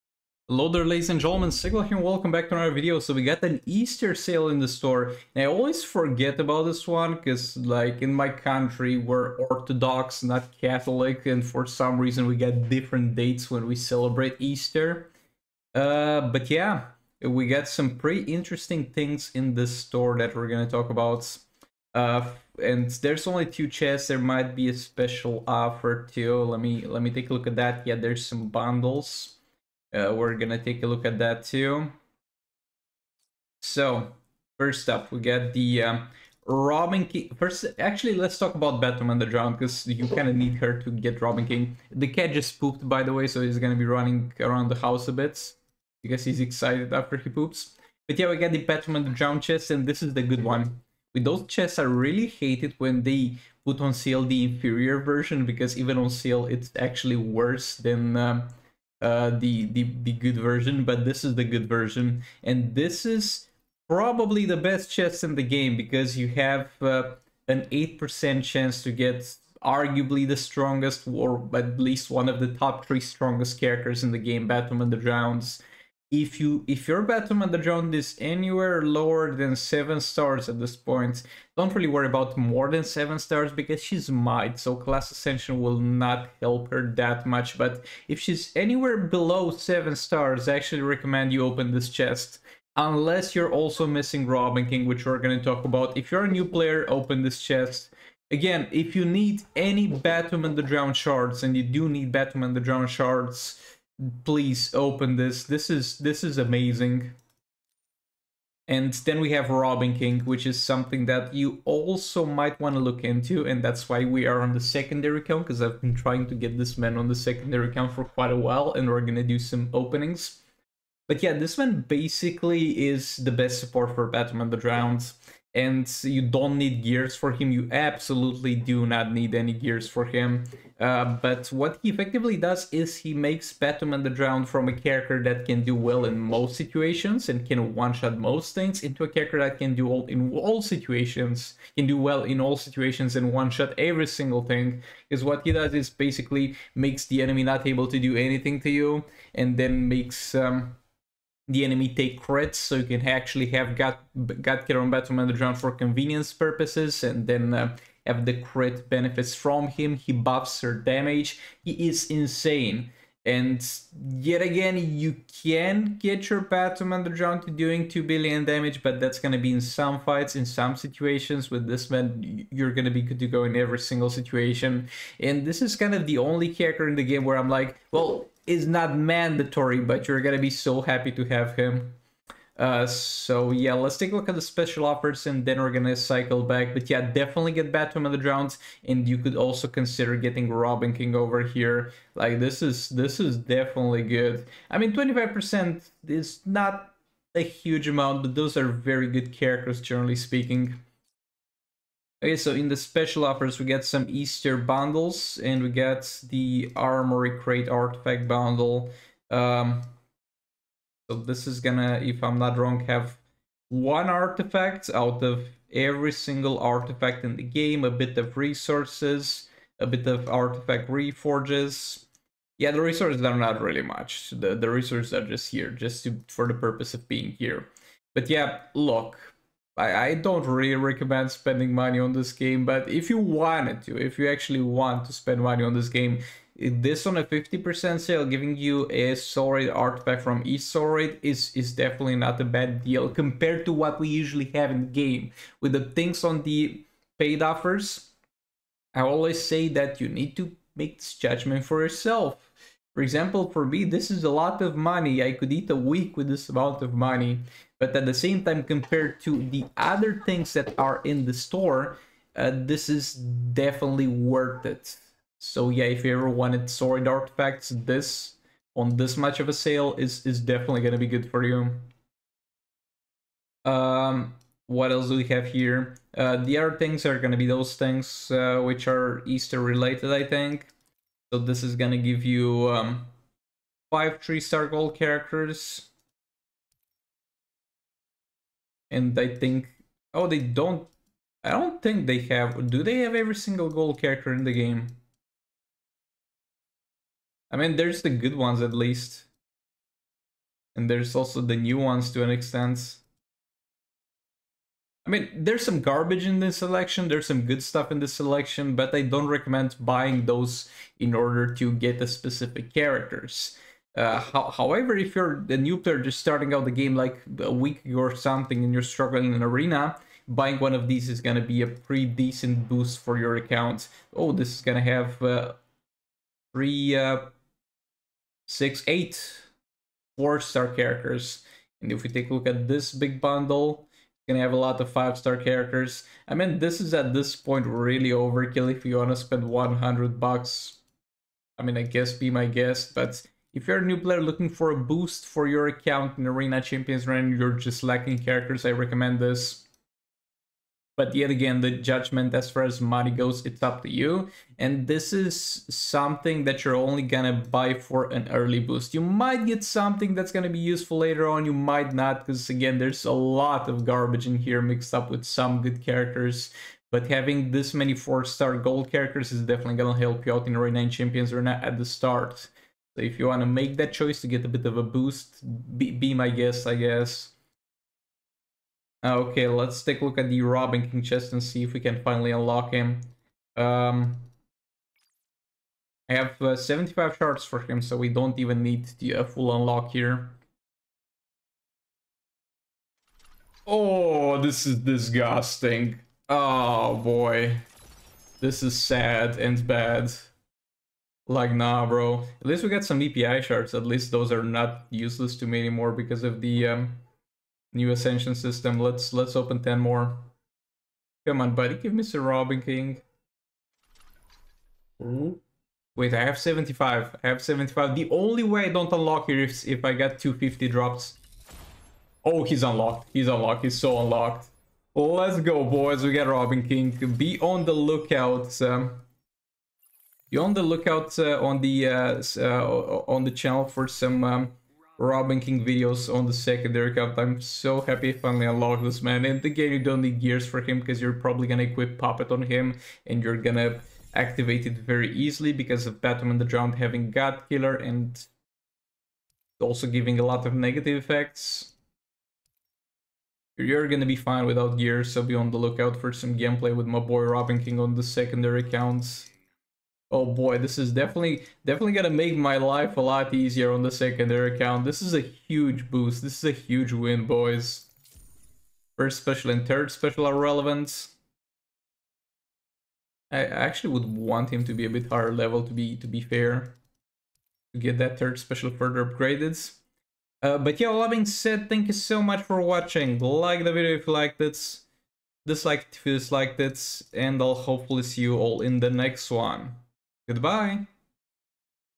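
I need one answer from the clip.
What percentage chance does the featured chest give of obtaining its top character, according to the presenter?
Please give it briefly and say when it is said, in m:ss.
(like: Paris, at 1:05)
8%, at 1:07.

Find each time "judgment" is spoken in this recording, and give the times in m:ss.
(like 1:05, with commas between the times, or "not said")
4:11, 5:51.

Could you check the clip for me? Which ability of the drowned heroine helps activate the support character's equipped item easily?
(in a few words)
God Killer.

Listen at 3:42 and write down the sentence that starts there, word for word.
Yeah, the resources are not really much.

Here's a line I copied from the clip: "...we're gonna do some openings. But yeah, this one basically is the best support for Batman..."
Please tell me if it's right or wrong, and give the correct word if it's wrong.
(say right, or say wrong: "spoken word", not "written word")
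right.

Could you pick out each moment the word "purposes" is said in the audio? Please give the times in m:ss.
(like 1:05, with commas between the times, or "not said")
2:36, 3:46.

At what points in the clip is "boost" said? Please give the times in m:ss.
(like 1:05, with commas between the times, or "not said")
5:22, 5:44, 5:58, 6:14, 7:45.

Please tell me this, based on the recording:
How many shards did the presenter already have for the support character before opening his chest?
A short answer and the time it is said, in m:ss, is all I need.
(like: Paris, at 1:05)
75, at 6:26.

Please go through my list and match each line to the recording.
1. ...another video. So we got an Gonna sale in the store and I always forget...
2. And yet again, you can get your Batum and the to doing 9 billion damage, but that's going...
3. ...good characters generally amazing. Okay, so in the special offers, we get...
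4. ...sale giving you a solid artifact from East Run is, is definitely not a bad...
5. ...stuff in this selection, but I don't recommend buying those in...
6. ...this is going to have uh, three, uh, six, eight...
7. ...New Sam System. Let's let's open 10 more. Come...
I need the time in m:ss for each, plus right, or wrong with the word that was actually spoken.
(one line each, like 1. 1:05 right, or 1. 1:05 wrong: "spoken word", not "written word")
1. 0:02 wrong: "Easter", not "Gonna"
2. 2:43 wrong: "2", not "9"
3. 3:19 wrong: "speaking", not "amazing"
4. 3:58 wrong: "Solid", not "Run"
5. 5:07 right
6. 5:24 right
7. 6:47 wrong: "Ascension", not "Sam".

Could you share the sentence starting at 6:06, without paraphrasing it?
But having this many 4-star gold characters is definitely gonna help you out in Arena 9 Champions Arena at the start.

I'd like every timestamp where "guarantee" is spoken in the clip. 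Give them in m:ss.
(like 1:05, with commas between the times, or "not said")
not said.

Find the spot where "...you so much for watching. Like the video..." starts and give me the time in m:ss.
8:01.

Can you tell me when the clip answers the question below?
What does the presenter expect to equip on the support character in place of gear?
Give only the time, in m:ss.
7:21.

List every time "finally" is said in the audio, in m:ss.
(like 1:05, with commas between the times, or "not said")
6:22, 7:18.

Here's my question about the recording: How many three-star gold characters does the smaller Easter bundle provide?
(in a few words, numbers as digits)
five.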